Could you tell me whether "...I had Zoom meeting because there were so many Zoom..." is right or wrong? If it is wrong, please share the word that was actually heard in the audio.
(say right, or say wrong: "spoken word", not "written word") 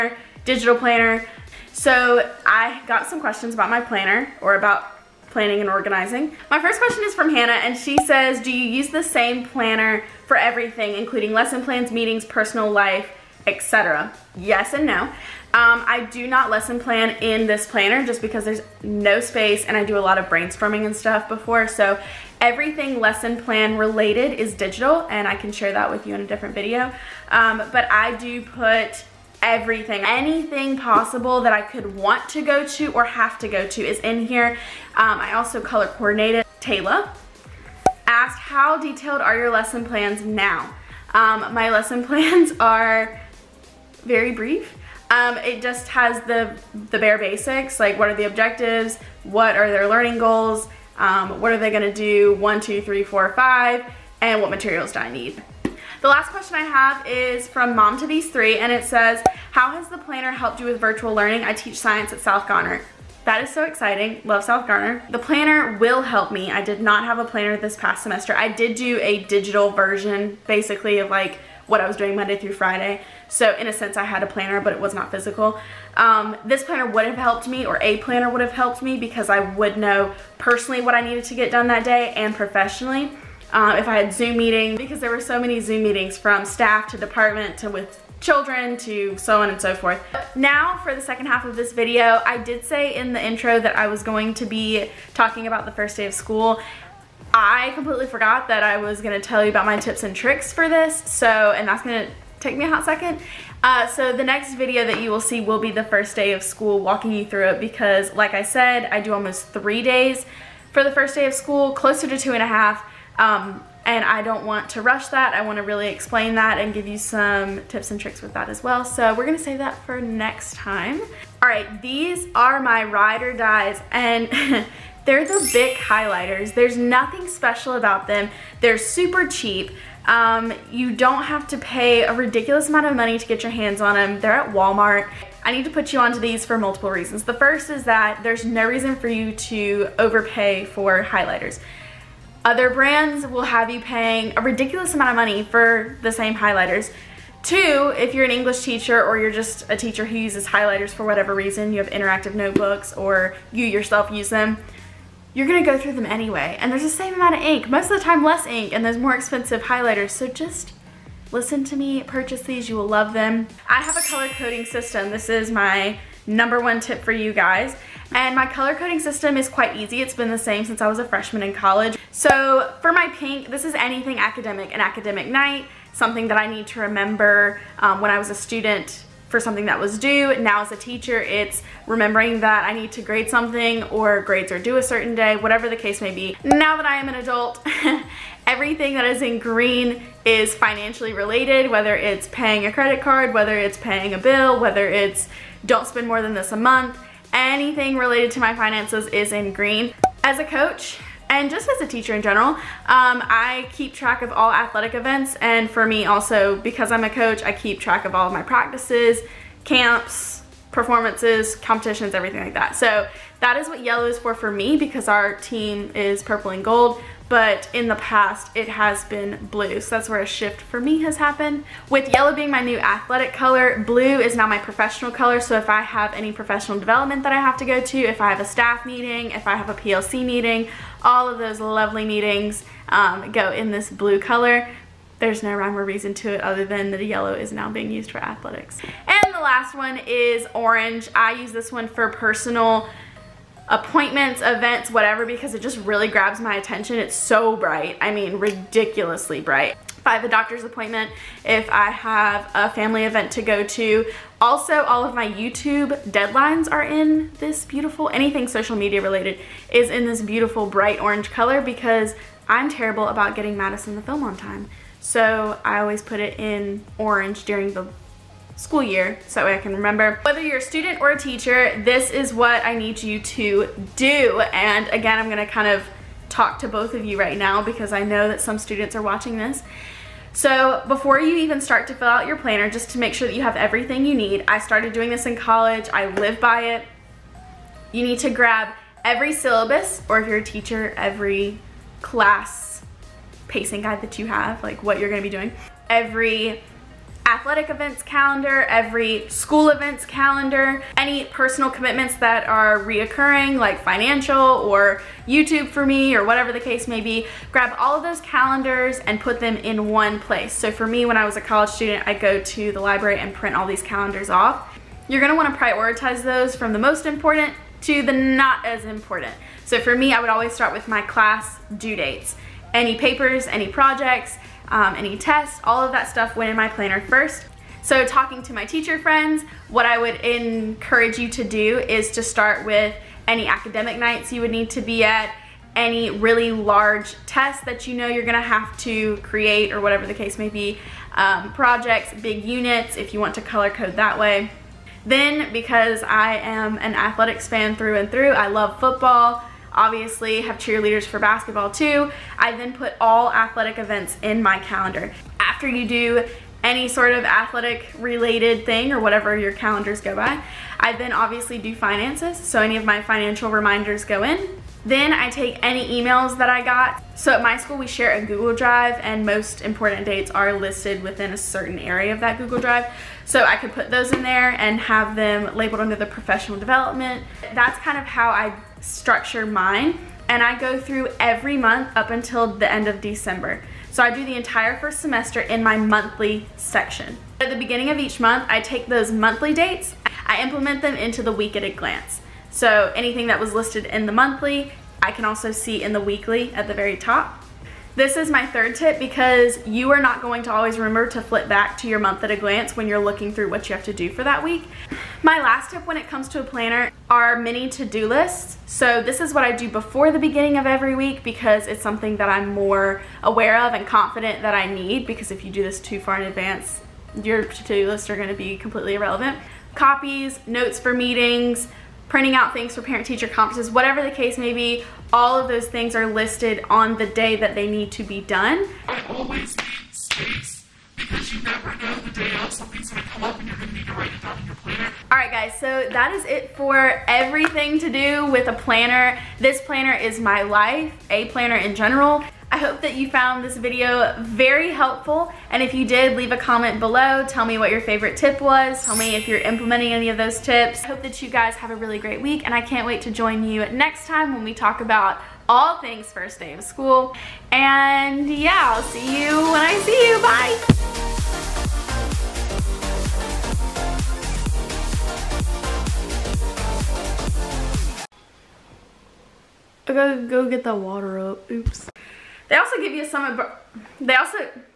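right.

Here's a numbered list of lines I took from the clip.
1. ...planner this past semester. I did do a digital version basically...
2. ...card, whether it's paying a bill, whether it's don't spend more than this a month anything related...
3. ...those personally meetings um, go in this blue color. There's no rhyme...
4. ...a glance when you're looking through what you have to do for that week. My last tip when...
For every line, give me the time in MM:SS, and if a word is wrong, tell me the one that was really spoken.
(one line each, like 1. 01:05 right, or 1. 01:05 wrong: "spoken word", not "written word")
1. 01:07 right
2. 03:12 right
3. 03:51 wrong: "lovely", not "personally"
4. 06:42 right.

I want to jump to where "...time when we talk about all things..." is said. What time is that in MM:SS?
07:34.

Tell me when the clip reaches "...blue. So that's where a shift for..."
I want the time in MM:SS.
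03:39.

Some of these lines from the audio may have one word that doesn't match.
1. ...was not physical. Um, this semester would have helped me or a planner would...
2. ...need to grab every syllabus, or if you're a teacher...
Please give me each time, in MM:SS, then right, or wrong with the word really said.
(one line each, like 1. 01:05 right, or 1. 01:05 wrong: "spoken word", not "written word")
1. 01:14 wrong: "planner", not "semester"
2. 04:48 right.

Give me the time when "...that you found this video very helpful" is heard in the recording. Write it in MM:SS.
07:22.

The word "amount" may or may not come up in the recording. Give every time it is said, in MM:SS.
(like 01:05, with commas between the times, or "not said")
02:12, 02:24, 02:37.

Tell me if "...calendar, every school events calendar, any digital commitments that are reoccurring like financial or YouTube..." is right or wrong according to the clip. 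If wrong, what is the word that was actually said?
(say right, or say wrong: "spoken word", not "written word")
wrong: "personal", not "digital".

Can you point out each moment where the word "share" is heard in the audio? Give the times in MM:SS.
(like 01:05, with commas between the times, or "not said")
00:25, 06:07.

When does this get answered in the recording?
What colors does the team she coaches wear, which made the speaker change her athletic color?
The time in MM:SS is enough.
03:36.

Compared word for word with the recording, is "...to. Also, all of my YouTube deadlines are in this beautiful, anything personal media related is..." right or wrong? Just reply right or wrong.
wrong.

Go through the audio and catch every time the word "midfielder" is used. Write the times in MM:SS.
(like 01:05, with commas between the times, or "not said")
not said.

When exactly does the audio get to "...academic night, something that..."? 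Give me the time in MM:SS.
02:54.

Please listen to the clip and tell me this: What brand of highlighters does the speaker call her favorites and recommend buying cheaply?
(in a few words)
Bic.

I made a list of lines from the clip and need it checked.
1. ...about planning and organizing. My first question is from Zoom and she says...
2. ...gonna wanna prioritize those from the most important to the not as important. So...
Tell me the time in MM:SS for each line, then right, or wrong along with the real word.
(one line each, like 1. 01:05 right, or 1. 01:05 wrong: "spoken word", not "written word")
1. 00:04 wrong: "Hannah", not "Zoom"
2. 05:15 right.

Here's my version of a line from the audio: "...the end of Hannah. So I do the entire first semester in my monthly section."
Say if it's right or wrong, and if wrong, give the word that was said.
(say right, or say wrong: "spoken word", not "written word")
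wrong: "December", not "Hannah".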